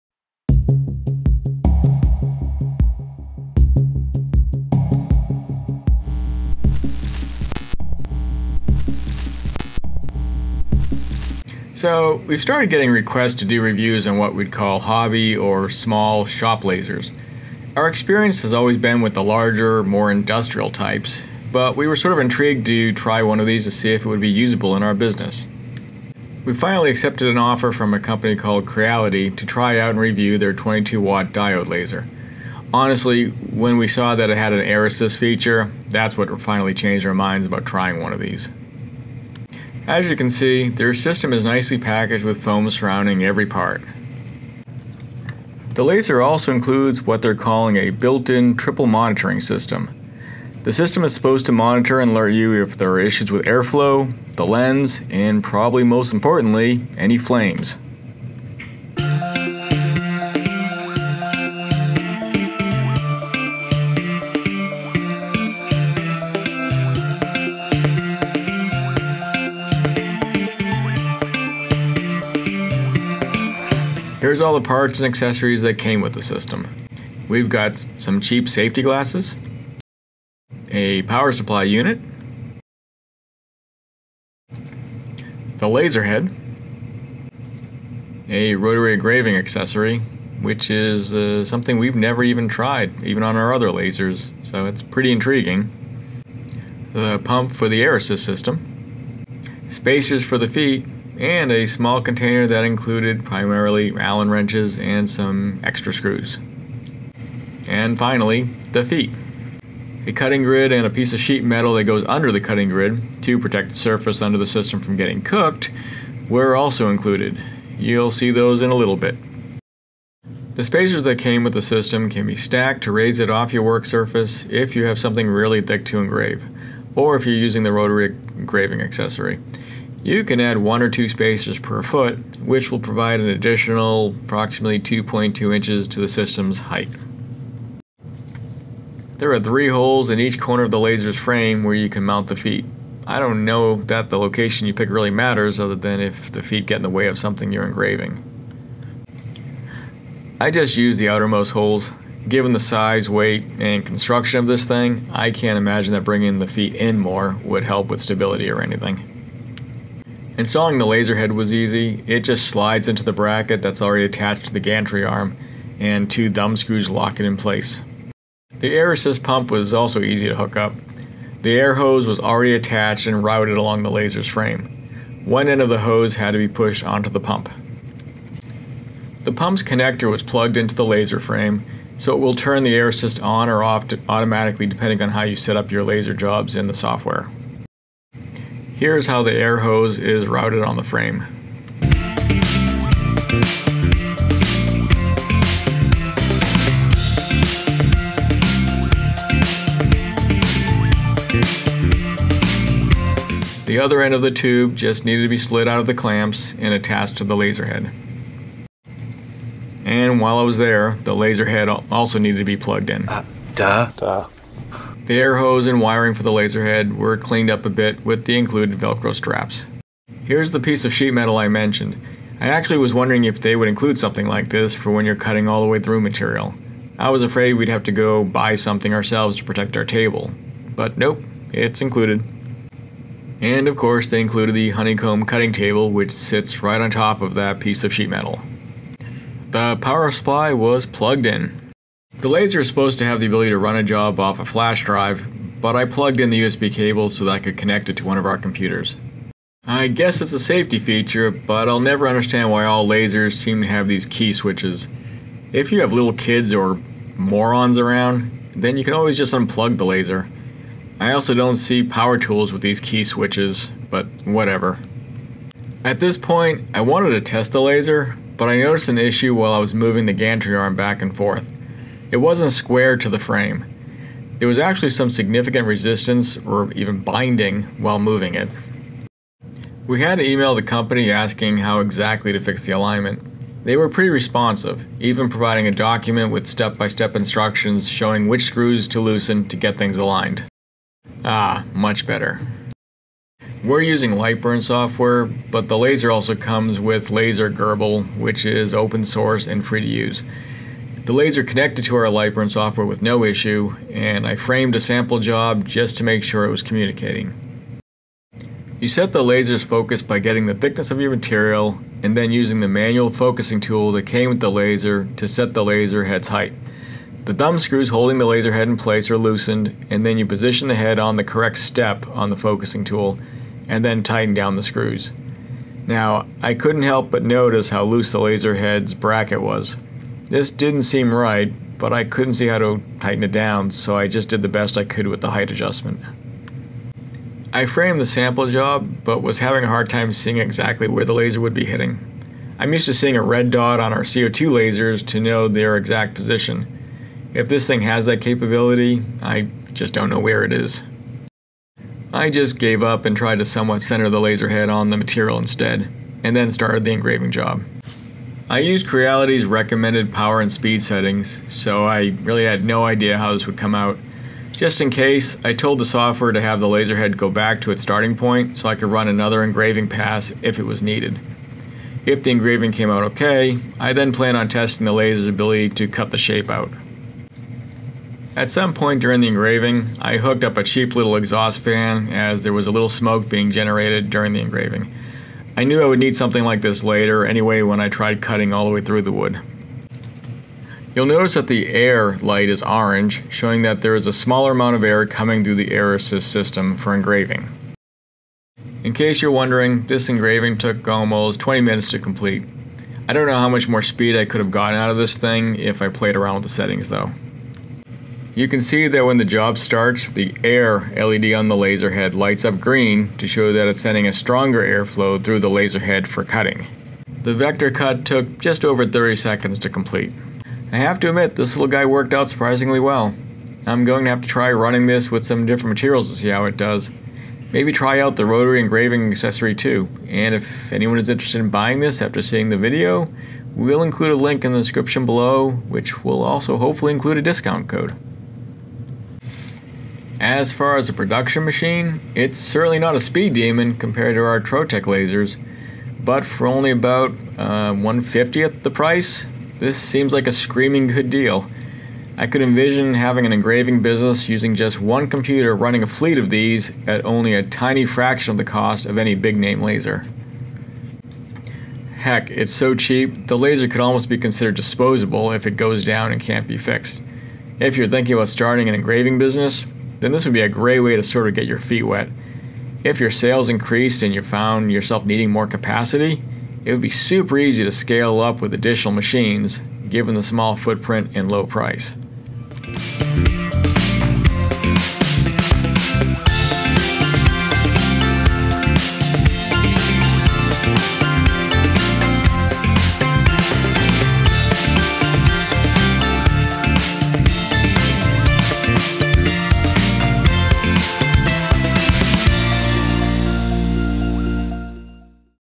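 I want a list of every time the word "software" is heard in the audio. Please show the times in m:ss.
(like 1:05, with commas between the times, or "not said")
3:06, 4:54, 5:02, 6:05.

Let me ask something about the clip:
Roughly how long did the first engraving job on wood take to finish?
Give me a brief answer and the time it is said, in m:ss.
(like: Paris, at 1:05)
almost 20 minutes, at 6:40.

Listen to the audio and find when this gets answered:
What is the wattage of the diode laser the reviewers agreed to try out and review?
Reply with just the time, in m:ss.
0:30.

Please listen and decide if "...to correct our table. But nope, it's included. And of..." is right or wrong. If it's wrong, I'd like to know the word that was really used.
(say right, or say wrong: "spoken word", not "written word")
wrong: "protect", not "correct".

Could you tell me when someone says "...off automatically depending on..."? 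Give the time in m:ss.
3:03.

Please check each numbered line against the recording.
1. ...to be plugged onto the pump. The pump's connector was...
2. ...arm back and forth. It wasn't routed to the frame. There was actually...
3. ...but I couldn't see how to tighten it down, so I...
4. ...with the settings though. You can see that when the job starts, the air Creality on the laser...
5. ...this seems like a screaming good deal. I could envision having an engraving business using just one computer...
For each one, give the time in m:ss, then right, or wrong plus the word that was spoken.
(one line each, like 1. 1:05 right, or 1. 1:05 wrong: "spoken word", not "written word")
1. 2:56 wrong: "pushed", not "plugged"
2. 4:30 wrong: "squared", not "routed"
3. 5:31 right
4. 6:46 wrong: "LED", not "Creality"
5. 7:29 right.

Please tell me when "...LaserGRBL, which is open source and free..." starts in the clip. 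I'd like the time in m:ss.
4:57.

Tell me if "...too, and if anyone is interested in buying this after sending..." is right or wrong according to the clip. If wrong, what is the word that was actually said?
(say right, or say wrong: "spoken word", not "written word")
wrong: "seeing", not "sending".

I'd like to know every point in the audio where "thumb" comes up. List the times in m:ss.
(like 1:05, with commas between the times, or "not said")
2:46, 5:17.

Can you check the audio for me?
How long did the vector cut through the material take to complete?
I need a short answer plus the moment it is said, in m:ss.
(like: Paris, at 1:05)
just over 30 seconds, at 6:58.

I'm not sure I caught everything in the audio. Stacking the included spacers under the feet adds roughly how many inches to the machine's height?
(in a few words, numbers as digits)
2.2 inches.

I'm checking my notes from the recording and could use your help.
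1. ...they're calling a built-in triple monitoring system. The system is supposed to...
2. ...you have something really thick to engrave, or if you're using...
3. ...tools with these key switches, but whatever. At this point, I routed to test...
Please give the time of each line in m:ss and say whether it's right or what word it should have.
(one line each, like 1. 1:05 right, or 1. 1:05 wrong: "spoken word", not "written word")
1. 0:47 right
2. 2:04 right
3. 4:22 wrong: "wanted", not "routed".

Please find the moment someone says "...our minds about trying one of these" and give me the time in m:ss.
0:37.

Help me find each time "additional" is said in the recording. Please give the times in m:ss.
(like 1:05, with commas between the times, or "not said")
2:13, 7:58.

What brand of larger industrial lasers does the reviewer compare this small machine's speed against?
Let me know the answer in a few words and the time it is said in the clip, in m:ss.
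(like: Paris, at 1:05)
Trotec, at 7:24.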